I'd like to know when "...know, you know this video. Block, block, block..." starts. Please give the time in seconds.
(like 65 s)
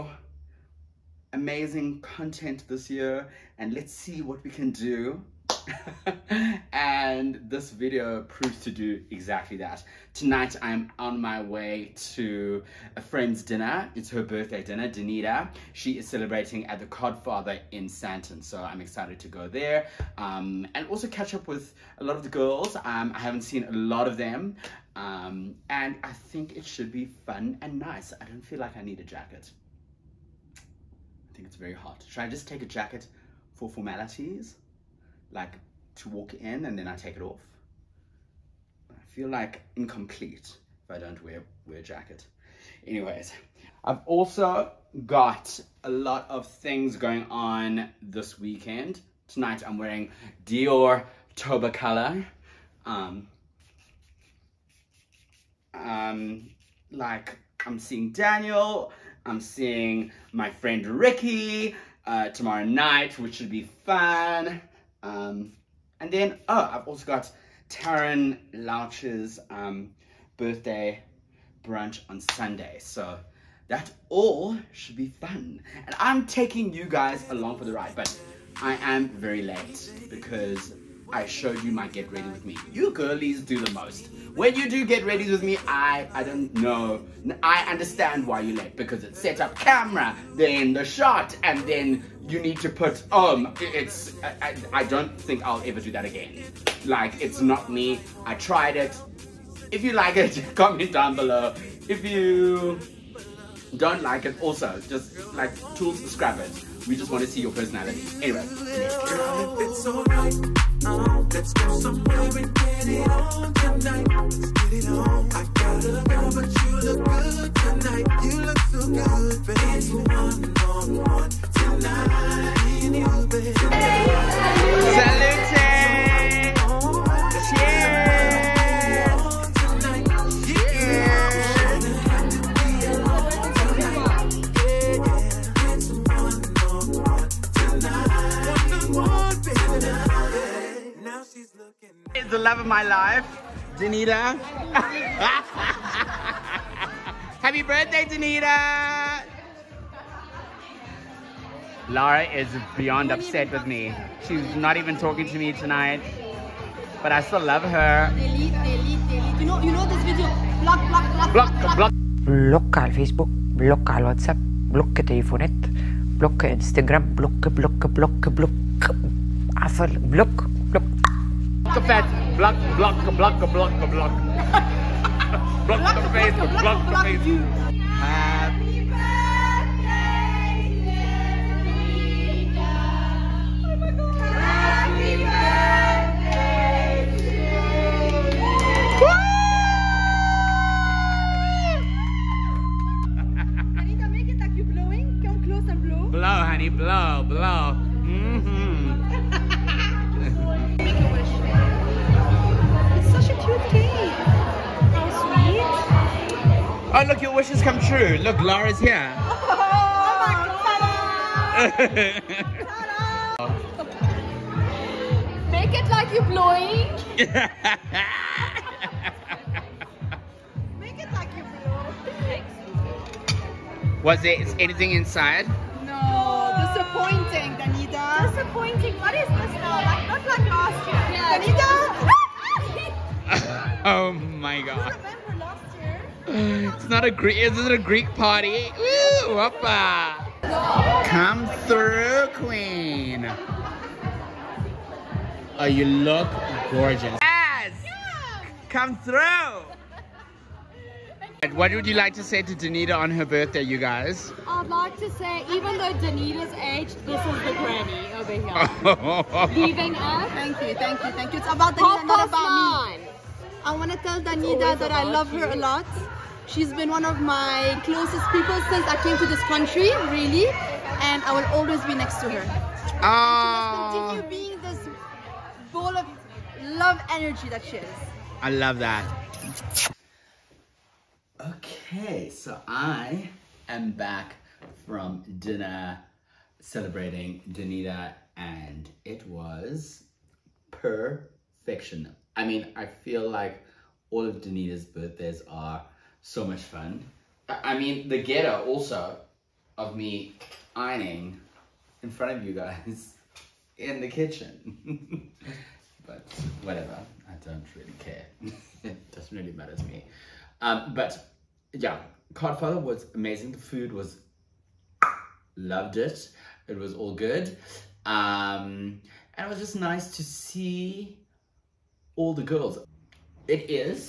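159 s.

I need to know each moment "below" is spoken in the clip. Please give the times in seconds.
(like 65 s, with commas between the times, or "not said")
101 s.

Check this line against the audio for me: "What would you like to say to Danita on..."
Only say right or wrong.
right.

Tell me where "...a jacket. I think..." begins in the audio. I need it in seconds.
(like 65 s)
28 s.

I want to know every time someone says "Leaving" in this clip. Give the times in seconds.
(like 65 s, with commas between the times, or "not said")
259 s.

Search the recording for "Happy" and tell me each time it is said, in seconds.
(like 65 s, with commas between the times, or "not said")
147 s, 177 s.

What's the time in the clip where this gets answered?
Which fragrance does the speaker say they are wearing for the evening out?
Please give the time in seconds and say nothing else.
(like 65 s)
50 s.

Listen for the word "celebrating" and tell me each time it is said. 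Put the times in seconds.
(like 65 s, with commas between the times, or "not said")
16 s, 286 s.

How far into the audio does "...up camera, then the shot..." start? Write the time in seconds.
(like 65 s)
89 s.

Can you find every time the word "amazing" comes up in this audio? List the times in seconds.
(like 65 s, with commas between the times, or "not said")
1 s, 313 s.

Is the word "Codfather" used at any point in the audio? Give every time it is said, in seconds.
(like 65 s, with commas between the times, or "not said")
16 s, 312 s.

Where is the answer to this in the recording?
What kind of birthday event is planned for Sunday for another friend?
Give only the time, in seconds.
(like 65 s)
70 s.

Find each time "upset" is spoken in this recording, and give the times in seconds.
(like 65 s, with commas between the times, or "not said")
153 s.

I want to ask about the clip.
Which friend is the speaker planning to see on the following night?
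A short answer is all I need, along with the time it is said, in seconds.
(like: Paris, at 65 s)
Ricky, at 60 s.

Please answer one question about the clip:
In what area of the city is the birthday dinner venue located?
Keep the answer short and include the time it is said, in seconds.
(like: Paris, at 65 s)
Sandton, at 17 s.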